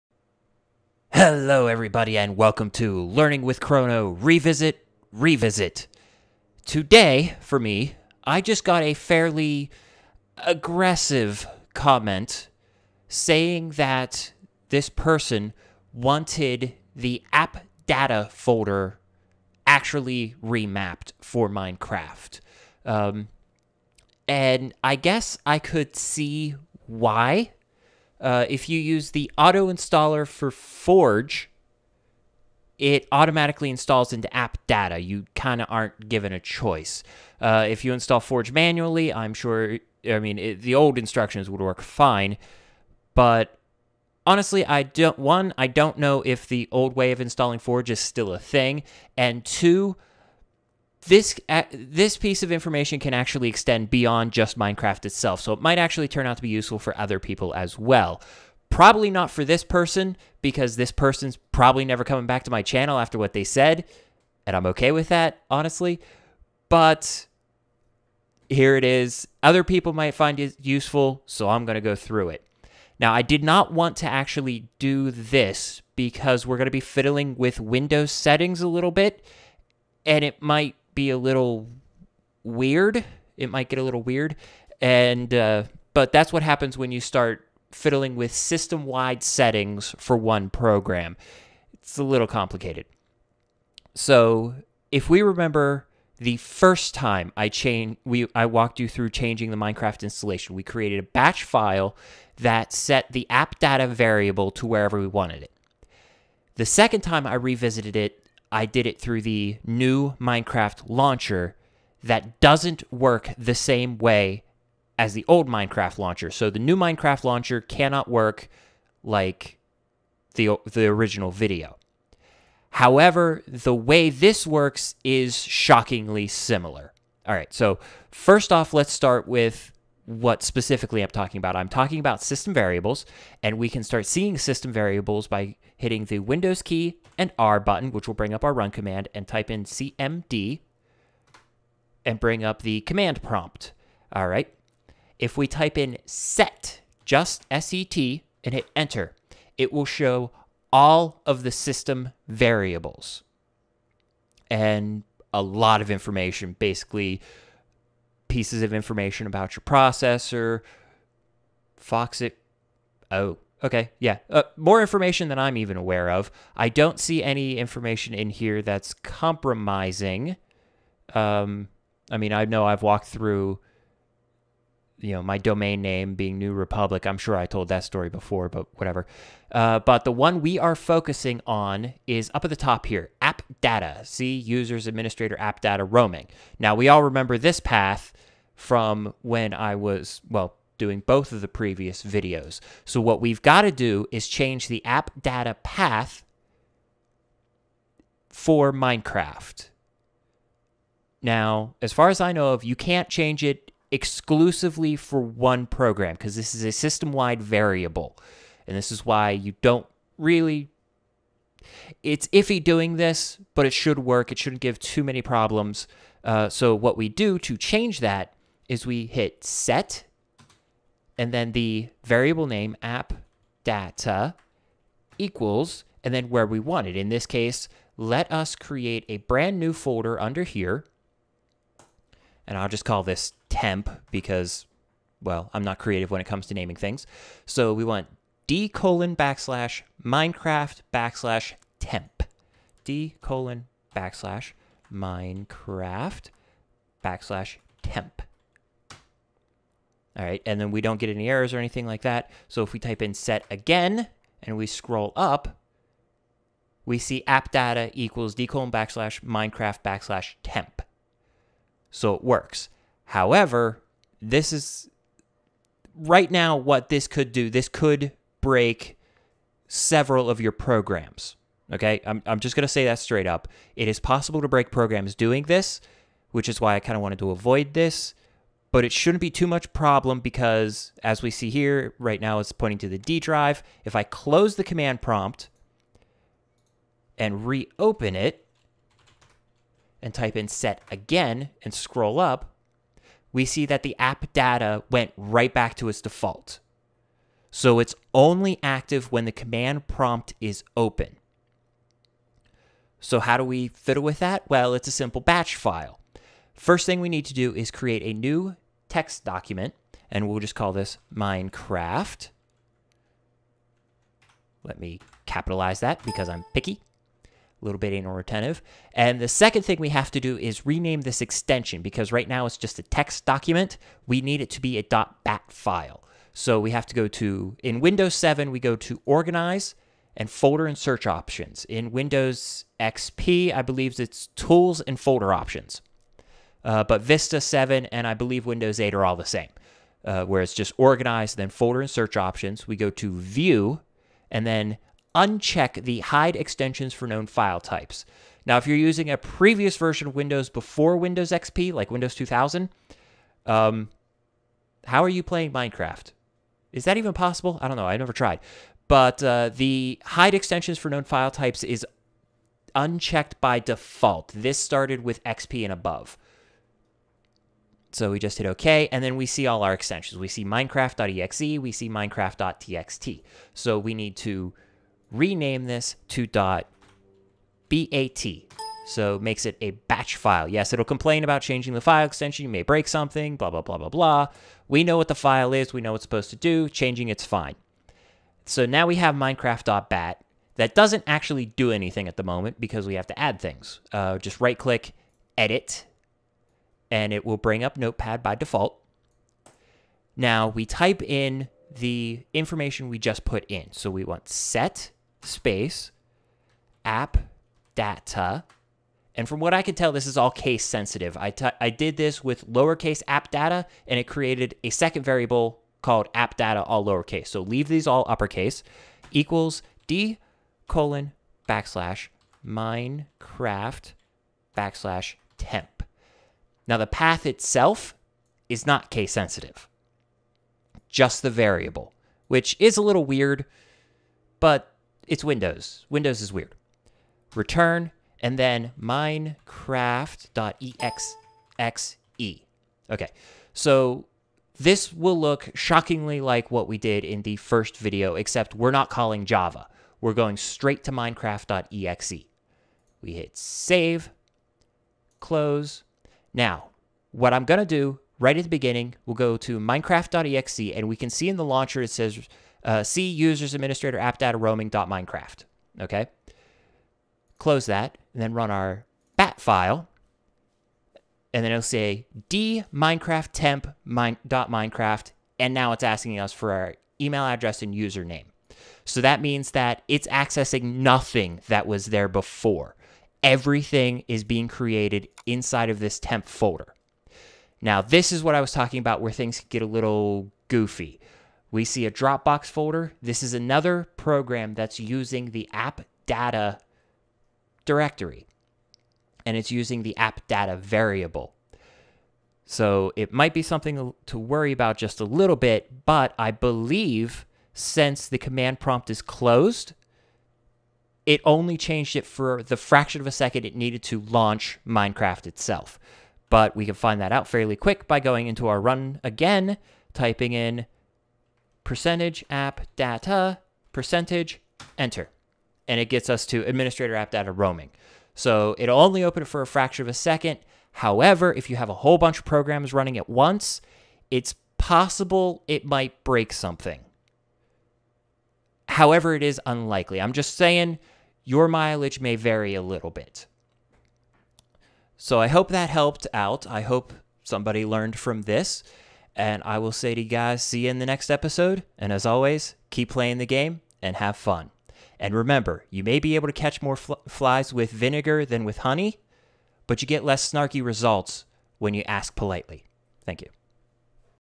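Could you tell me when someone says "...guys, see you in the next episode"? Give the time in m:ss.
9:10.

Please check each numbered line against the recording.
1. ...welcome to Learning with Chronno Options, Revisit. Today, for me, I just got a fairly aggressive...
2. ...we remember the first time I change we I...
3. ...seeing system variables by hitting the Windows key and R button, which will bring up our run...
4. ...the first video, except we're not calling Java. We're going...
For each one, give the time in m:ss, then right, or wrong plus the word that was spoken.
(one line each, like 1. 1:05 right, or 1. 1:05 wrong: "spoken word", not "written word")
1. 0:02 wrong: "Revisit", not "Options"
2. 1:35 right
3. 2:14 right
4. 7:27 right.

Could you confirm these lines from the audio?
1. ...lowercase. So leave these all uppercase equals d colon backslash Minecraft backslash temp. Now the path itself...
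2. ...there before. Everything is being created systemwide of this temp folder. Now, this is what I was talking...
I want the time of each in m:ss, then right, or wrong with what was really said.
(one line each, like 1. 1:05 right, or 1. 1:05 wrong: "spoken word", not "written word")
1. 6:56 right
2. 8:01 wrong: "inside", not "systemwide".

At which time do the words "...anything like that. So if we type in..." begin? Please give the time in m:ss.
4:11.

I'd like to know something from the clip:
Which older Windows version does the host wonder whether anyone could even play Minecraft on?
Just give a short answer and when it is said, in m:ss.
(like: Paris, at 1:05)
Windows 2000, at 5:51.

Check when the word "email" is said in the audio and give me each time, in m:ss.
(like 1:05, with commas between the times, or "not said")
7:57.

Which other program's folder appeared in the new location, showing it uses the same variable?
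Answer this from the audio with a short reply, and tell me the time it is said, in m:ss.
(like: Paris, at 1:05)
Dropbox, at 8:11.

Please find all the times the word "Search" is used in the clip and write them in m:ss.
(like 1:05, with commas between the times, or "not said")
5:30, 5:41.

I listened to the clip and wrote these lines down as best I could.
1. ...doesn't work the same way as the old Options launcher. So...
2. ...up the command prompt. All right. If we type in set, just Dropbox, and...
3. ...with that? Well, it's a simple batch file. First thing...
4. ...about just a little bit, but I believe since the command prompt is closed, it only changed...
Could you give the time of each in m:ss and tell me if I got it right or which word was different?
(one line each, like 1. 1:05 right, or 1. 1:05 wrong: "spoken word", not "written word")
1. 1:52 wrong: "Minecraft", not "Options"
2. 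2:22 wrong: "SET", not "Dropbox"
3. 5:04 right
4. 8:24 right.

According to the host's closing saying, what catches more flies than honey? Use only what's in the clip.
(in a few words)
vinegar.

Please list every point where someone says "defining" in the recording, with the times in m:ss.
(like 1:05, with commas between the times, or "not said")
not said.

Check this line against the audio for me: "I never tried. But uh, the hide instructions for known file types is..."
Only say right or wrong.
wrong.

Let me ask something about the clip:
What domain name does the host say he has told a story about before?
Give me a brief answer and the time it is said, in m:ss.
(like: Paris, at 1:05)
New Republic, at 2:56.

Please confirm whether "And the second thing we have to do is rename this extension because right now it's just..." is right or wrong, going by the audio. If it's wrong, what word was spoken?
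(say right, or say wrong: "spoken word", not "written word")
right.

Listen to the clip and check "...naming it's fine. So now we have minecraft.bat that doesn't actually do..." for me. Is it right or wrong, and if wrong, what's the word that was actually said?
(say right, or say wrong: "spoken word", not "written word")
wrong: "changing", not "naming".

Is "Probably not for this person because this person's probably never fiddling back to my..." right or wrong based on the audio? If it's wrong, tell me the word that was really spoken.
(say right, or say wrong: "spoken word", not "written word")
wrong: "coming", not "fiddling".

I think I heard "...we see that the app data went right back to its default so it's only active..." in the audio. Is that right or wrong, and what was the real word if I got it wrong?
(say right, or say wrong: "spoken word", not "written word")
right.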